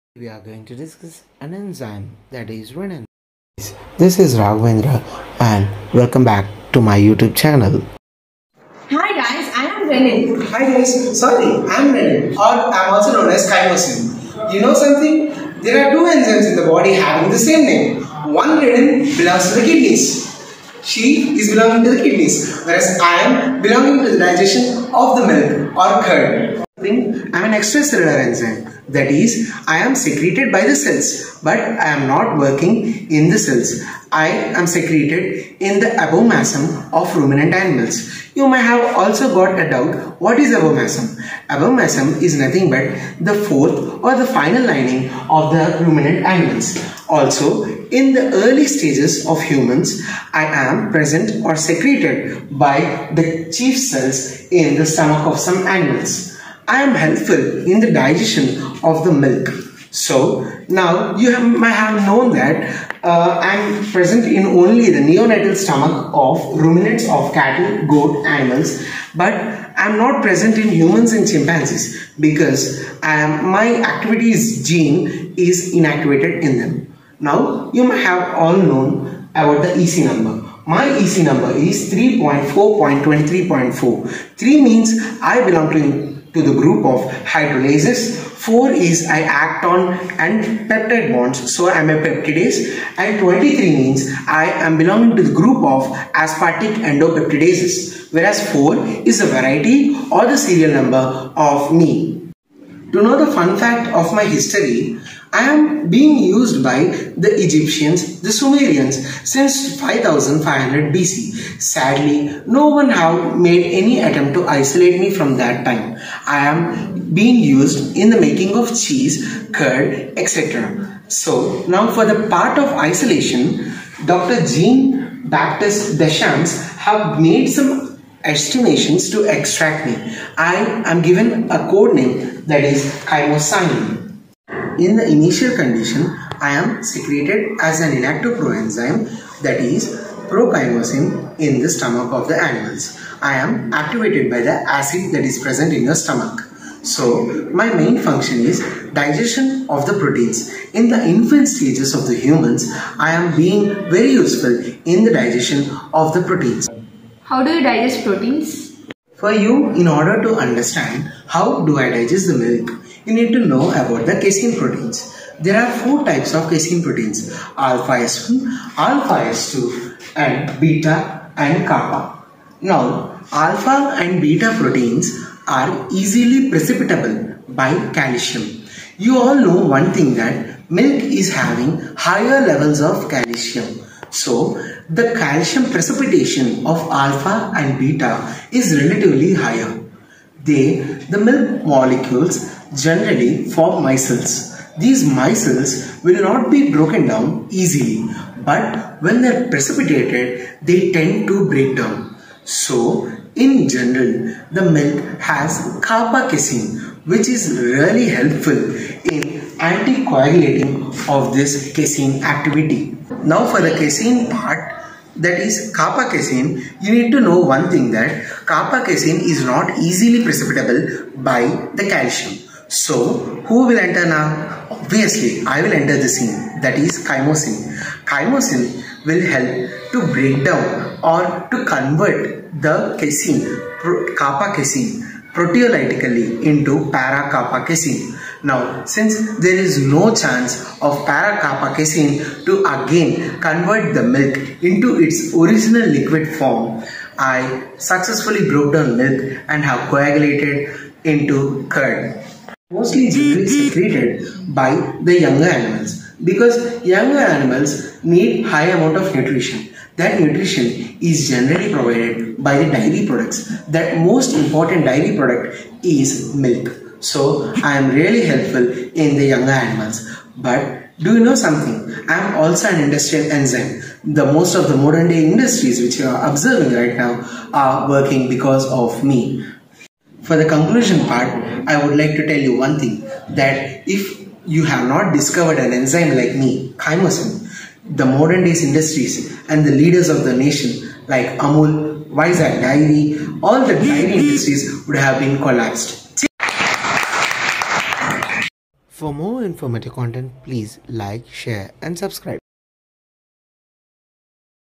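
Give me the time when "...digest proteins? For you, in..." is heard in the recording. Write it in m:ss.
2:37.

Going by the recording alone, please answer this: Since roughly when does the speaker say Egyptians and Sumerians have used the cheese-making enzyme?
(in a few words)
5500 BC.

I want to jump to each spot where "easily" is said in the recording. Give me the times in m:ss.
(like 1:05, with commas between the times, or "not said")
2:55, 3:17, 3:39.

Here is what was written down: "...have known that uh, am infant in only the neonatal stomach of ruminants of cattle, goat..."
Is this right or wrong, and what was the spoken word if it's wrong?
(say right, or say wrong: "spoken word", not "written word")
wrong: "present", not "infant".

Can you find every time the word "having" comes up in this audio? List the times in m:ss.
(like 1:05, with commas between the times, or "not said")
0:16, 3:01.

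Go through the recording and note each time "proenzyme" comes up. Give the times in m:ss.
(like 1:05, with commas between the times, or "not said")
2:18.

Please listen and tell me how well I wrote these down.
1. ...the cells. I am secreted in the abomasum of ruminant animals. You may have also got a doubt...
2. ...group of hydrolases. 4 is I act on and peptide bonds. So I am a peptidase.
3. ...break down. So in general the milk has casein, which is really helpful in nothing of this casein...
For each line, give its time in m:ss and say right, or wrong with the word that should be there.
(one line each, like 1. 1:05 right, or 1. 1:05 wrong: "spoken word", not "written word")
1. 0:33 right
2. 1:26 right
3. 3:21 wrong: "anticoagulating", not "nothing".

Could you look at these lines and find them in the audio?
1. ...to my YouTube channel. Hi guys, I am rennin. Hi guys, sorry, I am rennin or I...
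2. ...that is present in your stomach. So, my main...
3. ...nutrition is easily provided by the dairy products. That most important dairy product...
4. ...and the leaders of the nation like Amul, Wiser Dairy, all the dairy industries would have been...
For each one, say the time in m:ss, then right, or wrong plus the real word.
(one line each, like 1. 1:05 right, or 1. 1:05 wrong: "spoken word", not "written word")
1. 0:06 right
2. 2:25 right
3. 4:20 wrong: "generally", not "easily"
4. 4:49 right.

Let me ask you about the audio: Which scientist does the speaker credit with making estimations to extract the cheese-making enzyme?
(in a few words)
Jean Baptiste Deschamps.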